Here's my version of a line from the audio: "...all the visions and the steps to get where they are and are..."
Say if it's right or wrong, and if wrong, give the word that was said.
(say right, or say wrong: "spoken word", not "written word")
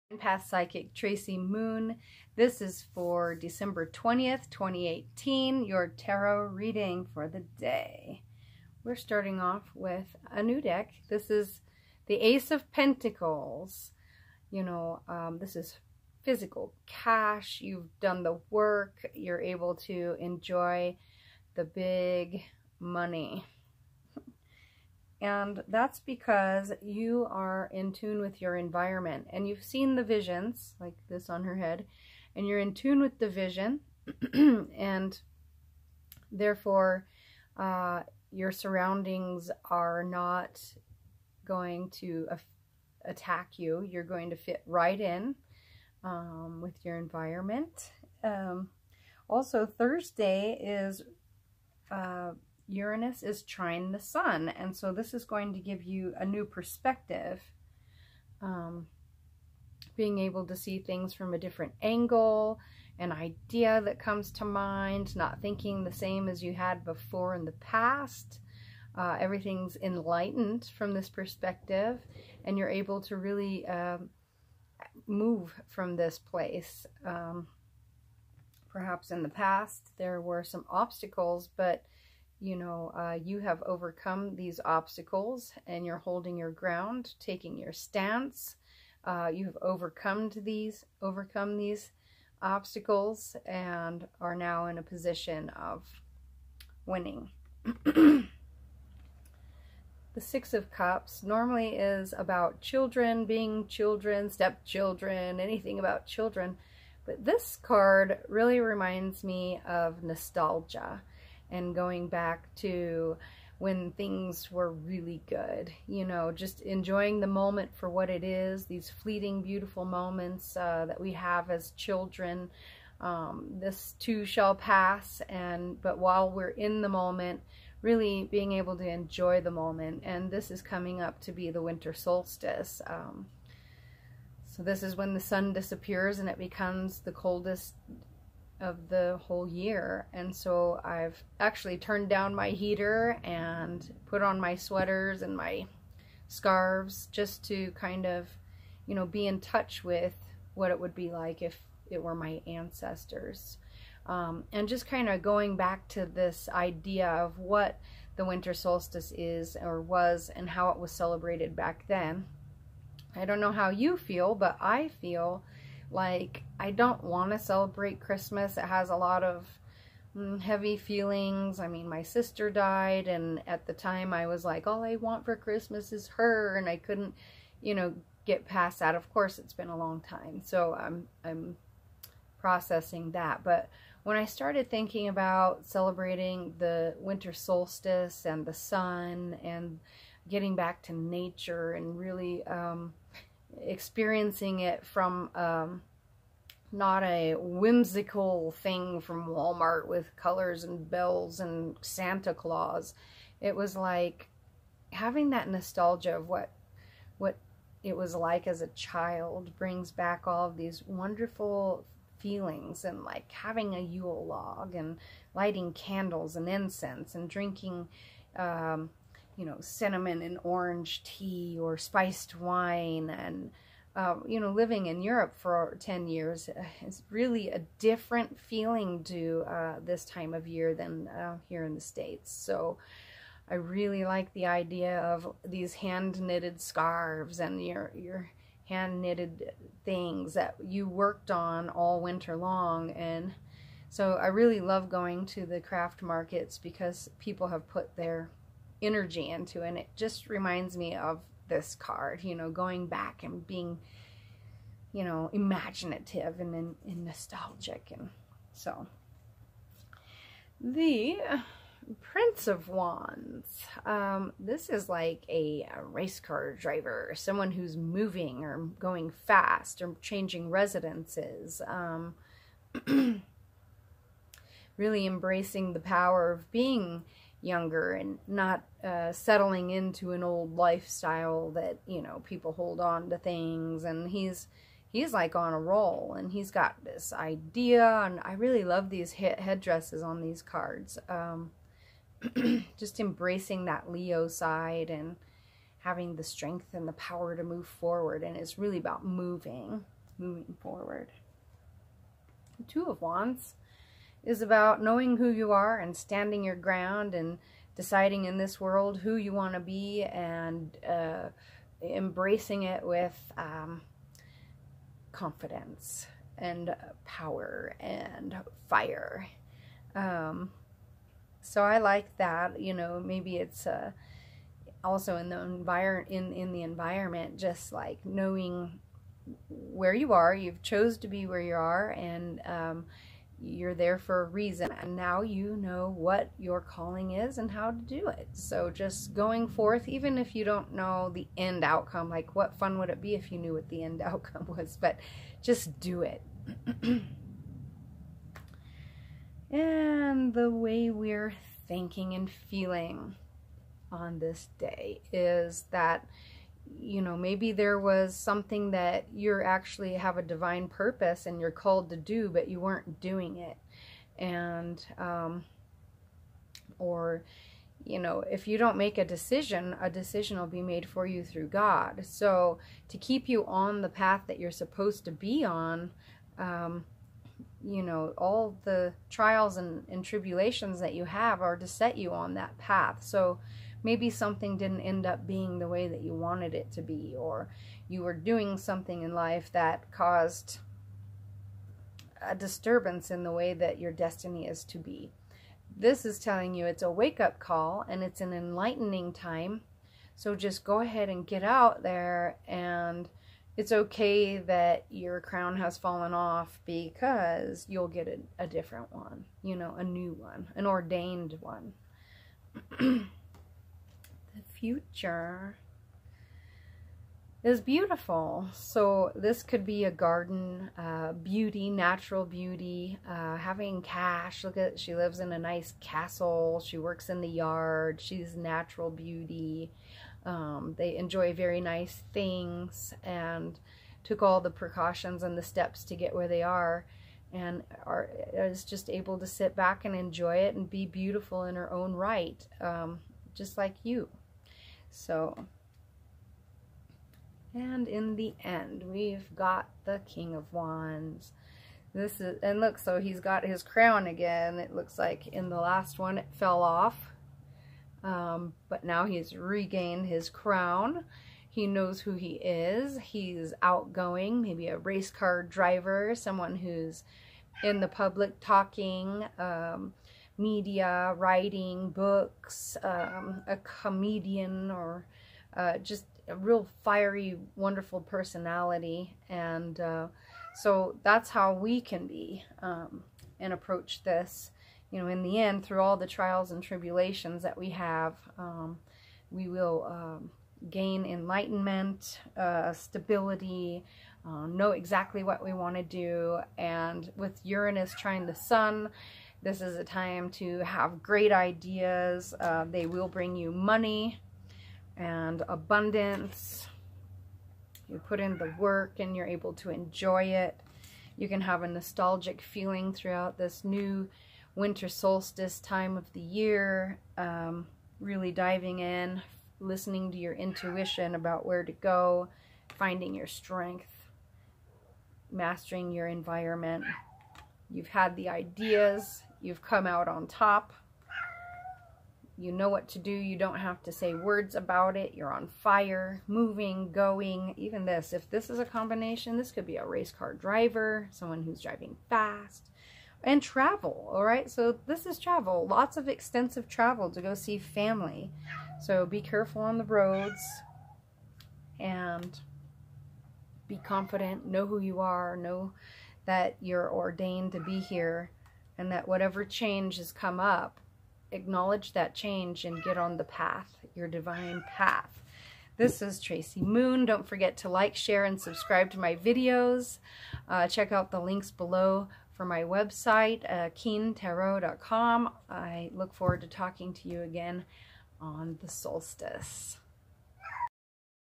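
wrong: "precautions", not "visions".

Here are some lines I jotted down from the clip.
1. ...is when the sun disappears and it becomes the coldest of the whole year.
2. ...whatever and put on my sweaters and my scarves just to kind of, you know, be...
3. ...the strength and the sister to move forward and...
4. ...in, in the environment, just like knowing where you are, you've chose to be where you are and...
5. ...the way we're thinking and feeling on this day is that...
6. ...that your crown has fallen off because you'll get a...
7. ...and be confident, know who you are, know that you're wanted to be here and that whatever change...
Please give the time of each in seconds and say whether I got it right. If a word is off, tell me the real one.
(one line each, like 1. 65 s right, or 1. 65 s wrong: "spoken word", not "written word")
1. 134 s right
2. 142 s wrong: "heater", not "whatever"
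3. 296 s wrong: "power", not "sister"
4. 326 s right
5. 350 s right
6. 404 s right
7. 551 s wrong: "ordained", not "wanted".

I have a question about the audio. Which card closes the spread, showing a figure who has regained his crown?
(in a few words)
King of Wands.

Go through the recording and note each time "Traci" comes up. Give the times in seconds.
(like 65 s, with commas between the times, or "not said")
0 s, 566 s.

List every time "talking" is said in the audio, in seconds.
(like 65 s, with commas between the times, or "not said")
468 s, 576 s.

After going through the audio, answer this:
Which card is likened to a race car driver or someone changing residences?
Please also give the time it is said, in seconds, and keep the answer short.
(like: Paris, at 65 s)
Prince of Wands, at 261 s.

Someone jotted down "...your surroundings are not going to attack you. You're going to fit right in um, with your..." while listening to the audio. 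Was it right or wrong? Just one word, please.
right.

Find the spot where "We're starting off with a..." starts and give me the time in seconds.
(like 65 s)
8 s.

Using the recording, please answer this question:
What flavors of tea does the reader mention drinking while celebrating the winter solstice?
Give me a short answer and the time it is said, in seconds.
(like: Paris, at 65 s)
Cinnamon and orange, at 219 s.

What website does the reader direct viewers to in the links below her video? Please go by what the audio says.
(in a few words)
keentarot.com.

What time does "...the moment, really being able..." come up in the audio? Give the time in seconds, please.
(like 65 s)
126 s.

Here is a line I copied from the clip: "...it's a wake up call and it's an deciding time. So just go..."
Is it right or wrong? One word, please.
wrong.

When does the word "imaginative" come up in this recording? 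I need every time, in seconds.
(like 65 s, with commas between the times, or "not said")
255 s.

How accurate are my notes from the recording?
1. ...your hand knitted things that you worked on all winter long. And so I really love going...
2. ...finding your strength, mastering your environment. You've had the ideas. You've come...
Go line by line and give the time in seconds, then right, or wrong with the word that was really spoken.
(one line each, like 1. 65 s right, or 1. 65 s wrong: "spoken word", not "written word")
1. 237 s right
2. 522 s right.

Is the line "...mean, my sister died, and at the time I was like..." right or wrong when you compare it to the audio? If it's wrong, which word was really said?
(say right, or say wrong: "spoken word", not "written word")
right.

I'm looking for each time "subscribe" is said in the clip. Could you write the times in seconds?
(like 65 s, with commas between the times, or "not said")
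568 s.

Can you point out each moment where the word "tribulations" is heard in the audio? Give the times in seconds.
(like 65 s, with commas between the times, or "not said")
380 s, 486 s.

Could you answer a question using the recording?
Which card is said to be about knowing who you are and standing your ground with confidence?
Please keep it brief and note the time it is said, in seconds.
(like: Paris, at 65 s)
Two of Wands, at 302 s.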